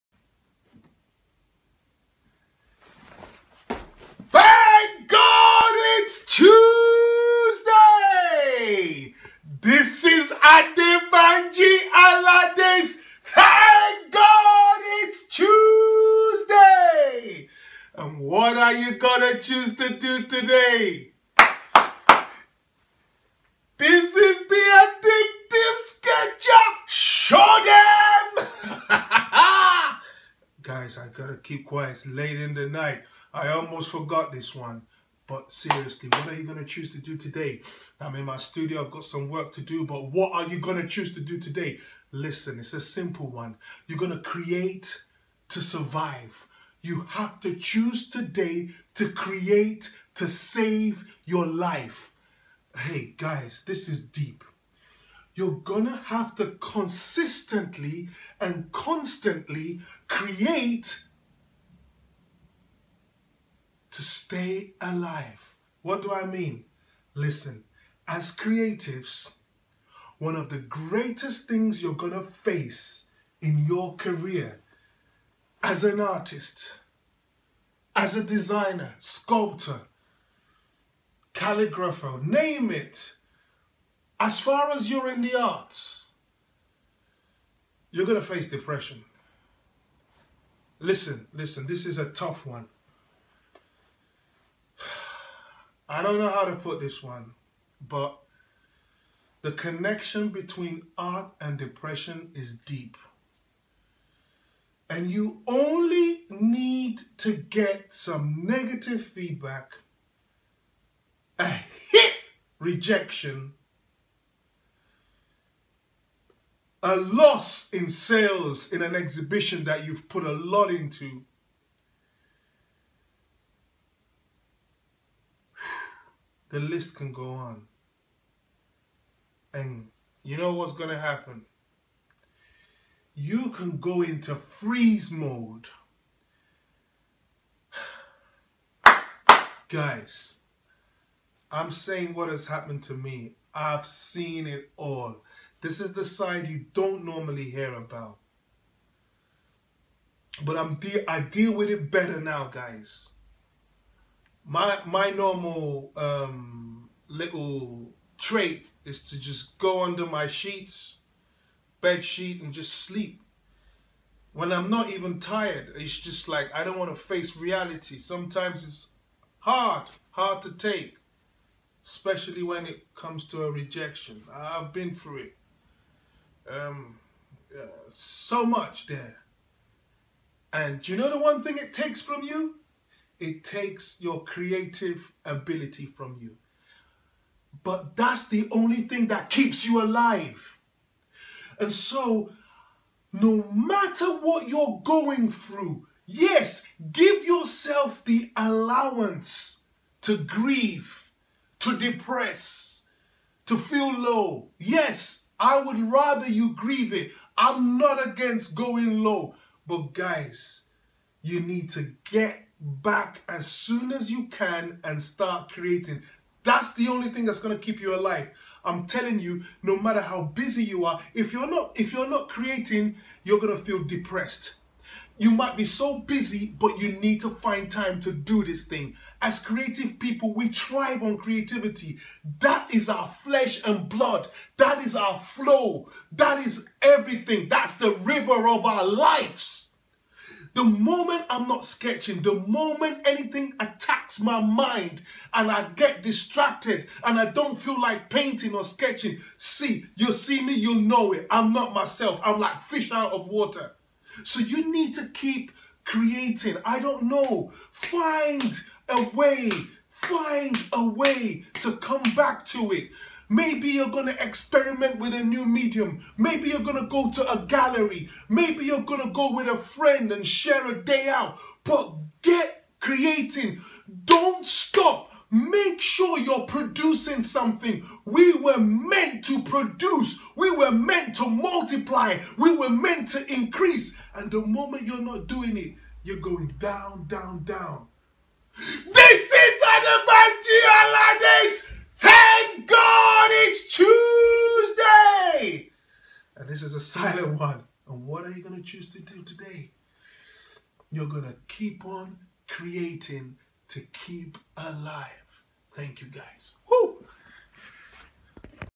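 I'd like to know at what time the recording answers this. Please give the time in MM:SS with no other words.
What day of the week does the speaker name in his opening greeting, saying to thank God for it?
00:15.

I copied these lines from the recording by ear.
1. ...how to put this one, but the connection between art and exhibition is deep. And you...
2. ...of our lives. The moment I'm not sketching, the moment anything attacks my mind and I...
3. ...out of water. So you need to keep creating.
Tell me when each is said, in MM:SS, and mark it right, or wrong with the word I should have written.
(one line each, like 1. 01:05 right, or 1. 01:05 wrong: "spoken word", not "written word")
1. 01:36 wrong: "depression", not "exhibition"
2. 03:58 right
3. 04:12 right.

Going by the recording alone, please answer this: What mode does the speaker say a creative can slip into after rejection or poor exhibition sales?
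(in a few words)
Freeze mode.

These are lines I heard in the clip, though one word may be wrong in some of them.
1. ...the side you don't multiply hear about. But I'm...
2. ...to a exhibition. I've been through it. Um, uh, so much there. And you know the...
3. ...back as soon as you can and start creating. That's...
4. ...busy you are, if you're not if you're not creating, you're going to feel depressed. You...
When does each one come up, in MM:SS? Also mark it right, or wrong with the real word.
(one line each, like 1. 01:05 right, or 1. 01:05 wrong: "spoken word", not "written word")
1. 02:25 wrong: "normally", not "multiply"
2. 02:53 wrong: "rejection", not "exhibition"
3. 03:32 right
4. 03:40 right.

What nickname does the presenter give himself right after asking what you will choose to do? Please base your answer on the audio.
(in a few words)
The Addictive Sketcher.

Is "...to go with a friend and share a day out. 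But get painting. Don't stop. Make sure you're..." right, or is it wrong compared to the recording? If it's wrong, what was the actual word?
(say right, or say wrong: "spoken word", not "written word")
wrong: "creating", not "painting".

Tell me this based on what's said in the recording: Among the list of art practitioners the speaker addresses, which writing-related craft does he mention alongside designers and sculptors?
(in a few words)
Calligrapher.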